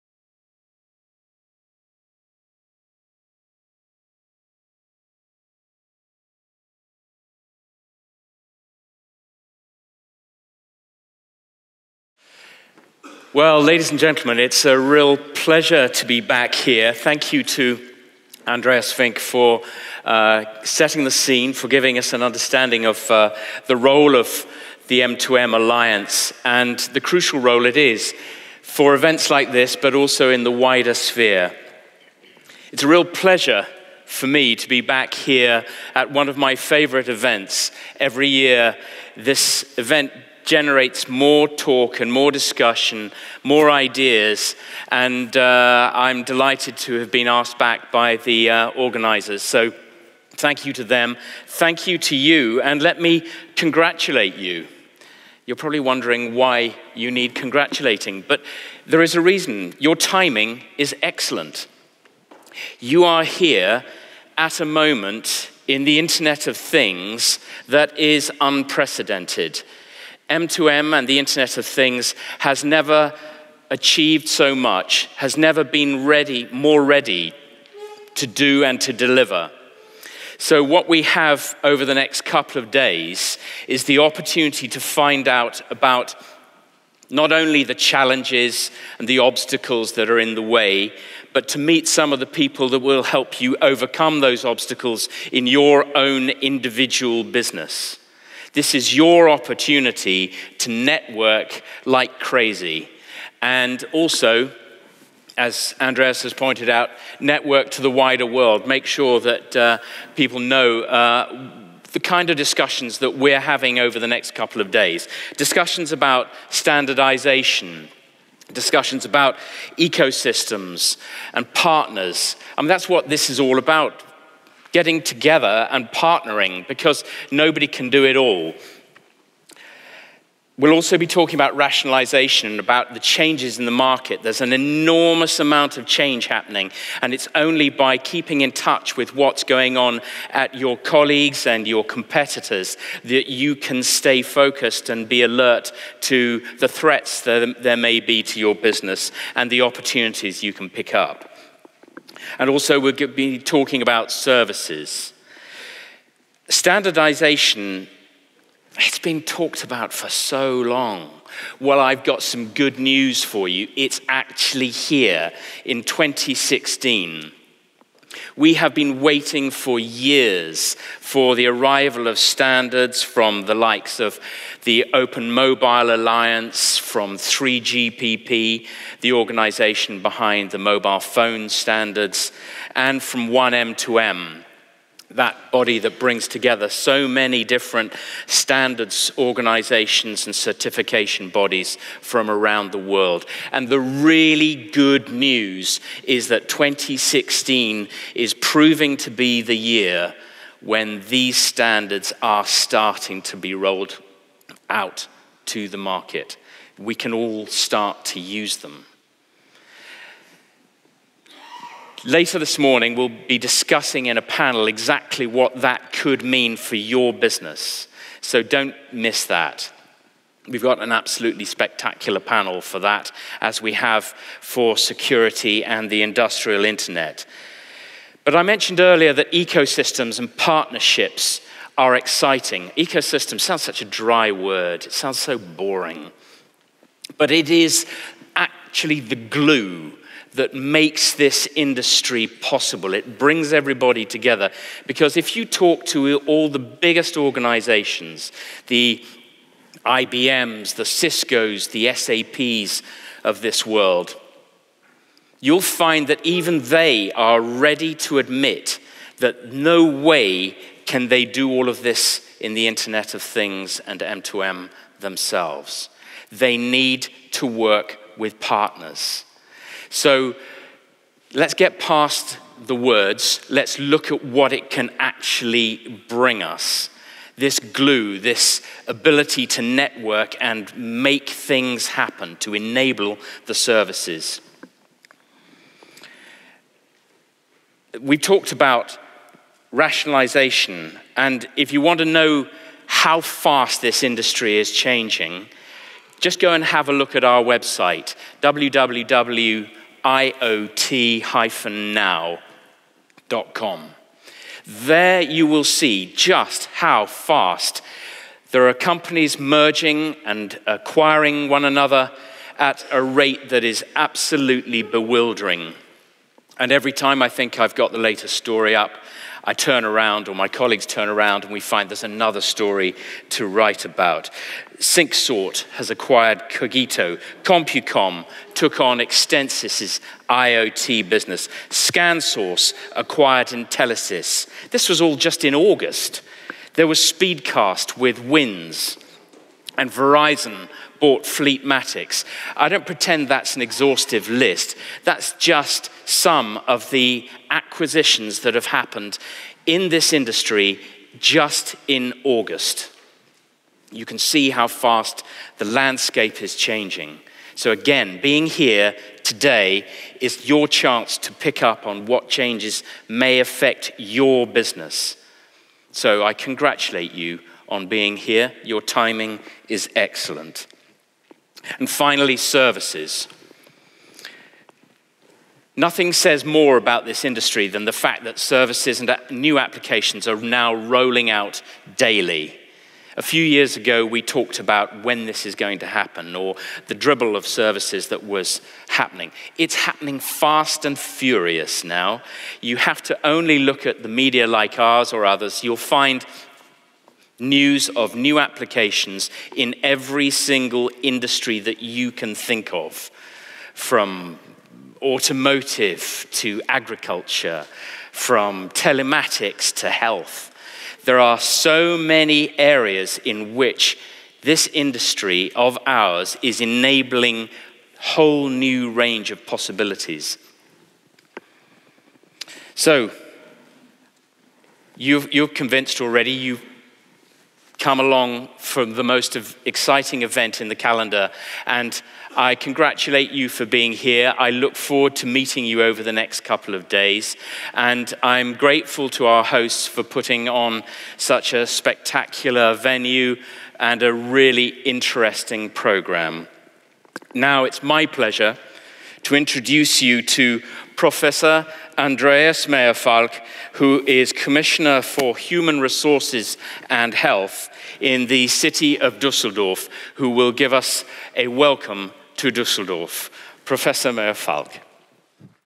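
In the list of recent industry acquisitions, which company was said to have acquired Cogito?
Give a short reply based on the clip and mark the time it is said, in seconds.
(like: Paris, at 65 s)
Syncsort, at 324 s.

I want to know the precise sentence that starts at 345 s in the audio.
That's just some of the acquisitions that have happened in this industry just in August.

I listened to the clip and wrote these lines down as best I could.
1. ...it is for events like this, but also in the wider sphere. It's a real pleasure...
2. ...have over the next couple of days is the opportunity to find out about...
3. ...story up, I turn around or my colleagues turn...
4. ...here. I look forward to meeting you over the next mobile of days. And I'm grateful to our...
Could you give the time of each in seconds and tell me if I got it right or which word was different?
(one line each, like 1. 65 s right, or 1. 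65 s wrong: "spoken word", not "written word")
1. 27 s right
2. 81 s right
3. 318 s right
4. 433 s wrong: "couple", not "mobile".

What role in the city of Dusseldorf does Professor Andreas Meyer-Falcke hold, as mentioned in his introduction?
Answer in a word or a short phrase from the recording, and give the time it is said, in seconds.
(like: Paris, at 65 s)
Commissioner for Human Resources and Health, at 454 s.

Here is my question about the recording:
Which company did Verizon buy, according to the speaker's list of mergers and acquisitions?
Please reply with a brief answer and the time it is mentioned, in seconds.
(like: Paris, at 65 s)
Fleetmatics, at 341 s.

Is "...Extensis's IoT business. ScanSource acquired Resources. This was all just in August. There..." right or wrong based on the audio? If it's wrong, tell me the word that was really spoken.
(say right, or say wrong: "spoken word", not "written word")
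wrong: "Intelisys", not "Resources".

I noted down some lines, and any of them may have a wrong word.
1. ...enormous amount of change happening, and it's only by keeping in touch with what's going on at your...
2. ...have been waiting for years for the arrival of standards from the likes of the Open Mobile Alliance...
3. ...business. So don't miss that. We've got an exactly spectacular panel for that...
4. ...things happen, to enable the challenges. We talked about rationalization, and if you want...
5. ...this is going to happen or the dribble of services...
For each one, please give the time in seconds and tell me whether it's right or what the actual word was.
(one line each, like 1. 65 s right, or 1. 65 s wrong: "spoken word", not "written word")
1. 134 s right
2. 168 s right
3. 217 s wrong: "absolutely", not "exactly"
4. 281 s wrong: "services", not "challenges"
5. 385 s right.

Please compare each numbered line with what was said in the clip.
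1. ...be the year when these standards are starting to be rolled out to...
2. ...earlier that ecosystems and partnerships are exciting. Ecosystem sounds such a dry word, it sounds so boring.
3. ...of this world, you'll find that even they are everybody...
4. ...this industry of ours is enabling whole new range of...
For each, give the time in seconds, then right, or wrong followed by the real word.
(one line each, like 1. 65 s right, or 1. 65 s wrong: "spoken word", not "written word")
1. 199 s right
2. 228 s right
3. 253 s wrong: "ready", not "everybody"
4. 414 s right.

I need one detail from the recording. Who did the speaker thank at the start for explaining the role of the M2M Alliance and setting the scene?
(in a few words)
Andreas Fink.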